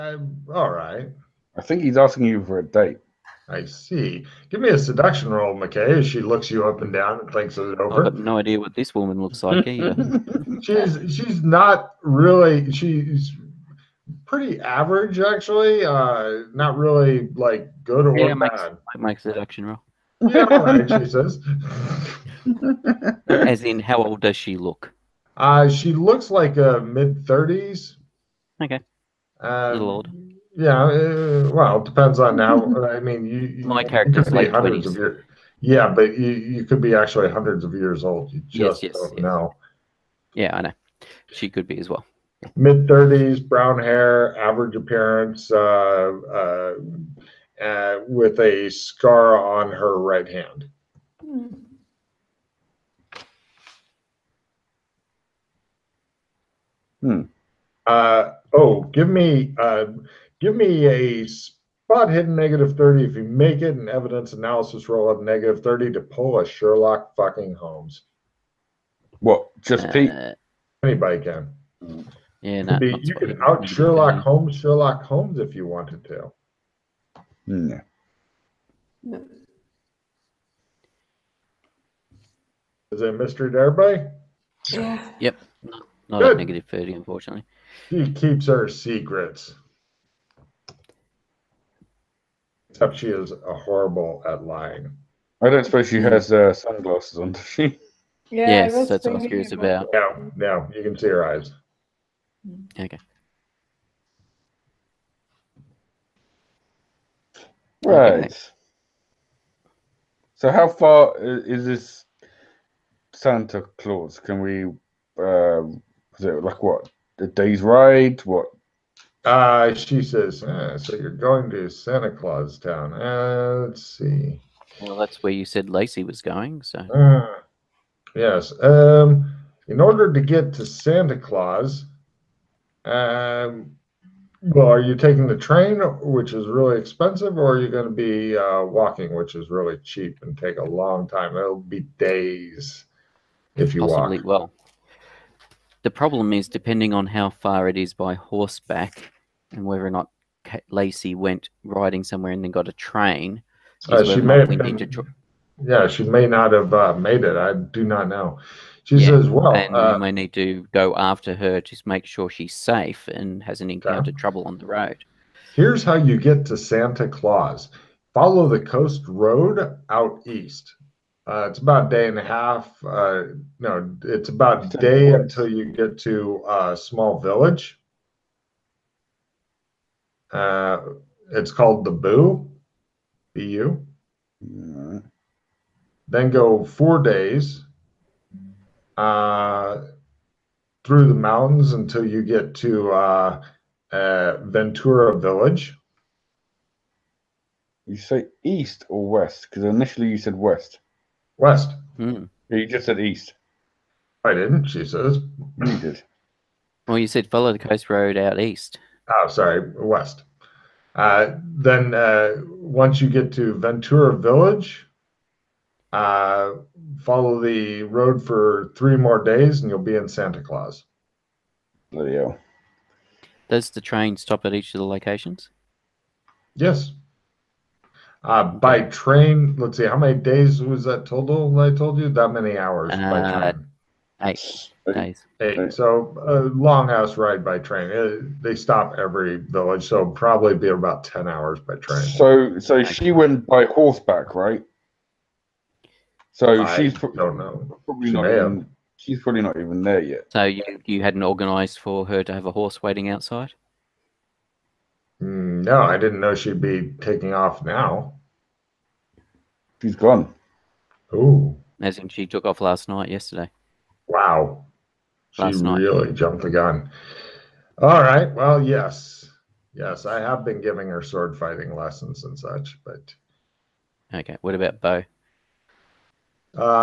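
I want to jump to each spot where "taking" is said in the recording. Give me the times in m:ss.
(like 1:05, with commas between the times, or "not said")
2:14, 4:17.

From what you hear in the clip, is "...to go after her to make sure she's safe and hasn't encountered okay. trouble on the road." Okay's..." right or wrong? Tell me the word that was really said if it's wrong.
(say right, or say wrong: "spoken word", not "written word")
wrong: "Here", not "Okay".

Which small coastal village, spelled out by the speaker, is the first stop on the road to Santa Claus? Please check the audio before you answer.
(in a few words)
Boo.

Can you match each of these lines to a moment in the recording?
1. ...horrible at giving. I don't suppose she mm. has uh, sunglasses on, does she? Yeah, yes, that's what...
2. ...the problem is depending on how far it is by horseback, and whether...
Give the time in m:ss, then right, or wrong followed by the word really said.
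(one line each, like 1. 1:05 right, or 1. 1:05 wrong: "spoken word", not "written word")
1. 1:33 wrong: "lying", not "giving"
2. 2:25 right.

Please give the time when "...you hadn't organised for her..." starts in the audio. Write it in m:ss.
4:10.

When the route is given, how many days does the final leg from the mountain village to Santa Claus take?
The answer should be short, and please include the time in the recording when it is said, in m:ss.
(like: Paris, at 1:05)
3 days, at 3:38.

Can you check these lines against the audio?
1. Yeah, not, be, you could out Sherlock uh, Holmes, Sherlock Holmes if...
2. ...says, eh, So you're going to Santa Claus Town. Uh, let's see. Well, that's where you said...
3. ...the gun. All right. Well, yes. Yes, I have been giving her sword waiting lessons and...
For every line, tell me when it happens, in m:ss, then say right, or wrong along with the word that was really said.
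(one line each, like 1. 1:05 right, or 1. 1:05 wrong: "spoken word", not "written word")
1. 1:12 right
2. 2:00 right
3. 4:26 wrong: "fighting", not "waiting".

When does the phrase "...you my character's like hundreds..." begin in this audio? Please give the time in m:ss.
0:33.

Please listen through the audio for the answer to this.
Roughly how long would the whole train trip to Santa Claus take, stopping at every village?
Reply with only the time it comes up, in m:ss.
4:01.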